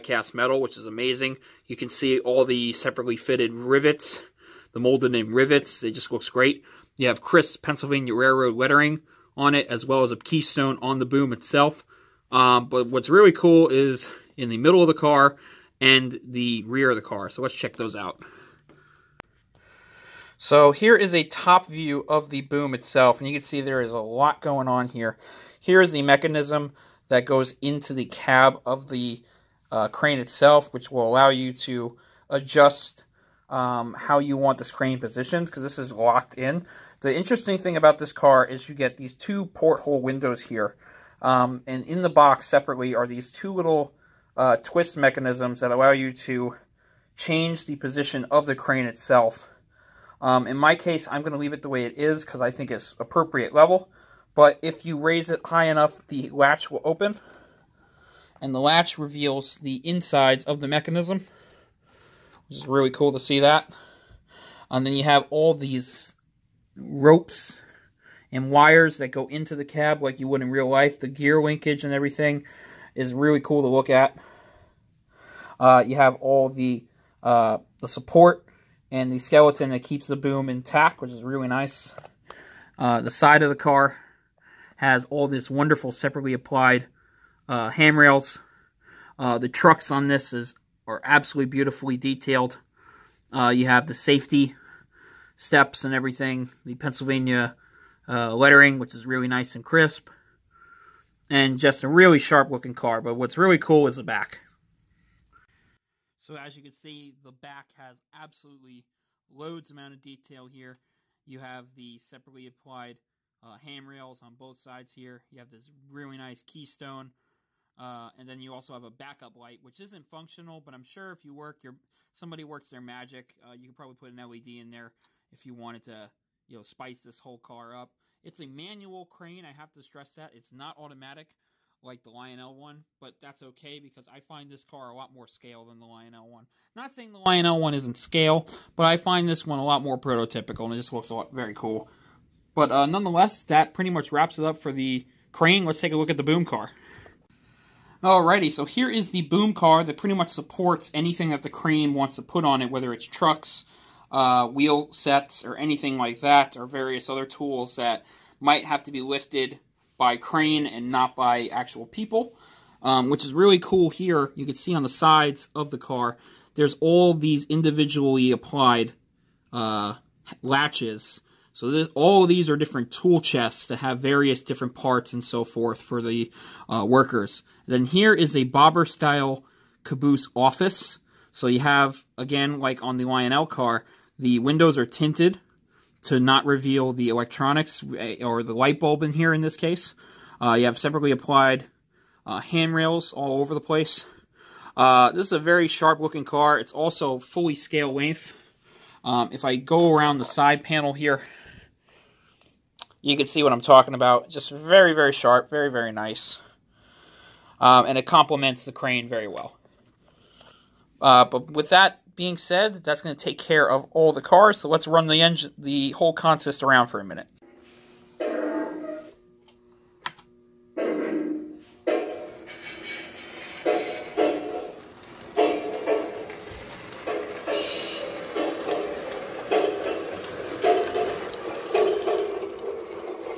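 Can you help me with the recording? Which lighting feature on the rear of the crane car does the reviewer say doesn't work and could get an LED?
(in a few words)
backup light.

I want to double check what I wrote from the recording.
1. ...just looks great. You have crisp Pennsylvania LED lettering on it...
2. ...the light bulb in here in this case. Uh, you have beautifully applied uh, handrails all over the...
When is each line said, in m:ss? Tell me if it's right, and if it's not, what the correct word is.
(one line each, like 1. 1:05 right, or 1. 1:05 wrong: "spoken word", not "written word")
1. 0:05 wrong: "Railroad", not "LED"
2. 3:08 wrong: "separately", not "beautifully".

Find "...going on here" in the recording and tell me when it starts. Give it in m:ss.
0:24.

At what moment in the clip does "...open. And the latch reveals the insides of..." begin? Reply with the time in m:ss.
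0:56.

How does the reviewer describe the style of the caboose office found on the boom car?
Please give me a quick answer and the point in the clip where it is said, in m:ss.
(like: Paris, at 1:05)
bobber-style, at 2:58.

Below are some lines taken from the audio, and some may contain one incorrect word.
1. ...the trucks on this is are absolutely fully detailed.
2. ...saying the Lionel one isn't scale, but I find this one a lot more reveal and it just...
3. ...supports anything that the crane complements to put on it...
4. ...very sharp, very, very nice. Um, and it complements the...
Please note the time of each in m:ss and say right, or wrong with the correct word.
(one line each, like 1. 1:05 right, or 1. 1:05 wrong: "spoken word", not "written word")
1. 1:29 wrong: "beautifully", not "fully"
2. 2:16 wrong: "prototypical", not "reveal"
3. 2:30 wrong: "wants", not "complements"
4. 3:24 right.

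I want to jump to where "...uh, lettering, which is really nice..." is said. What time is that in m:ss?
1:38.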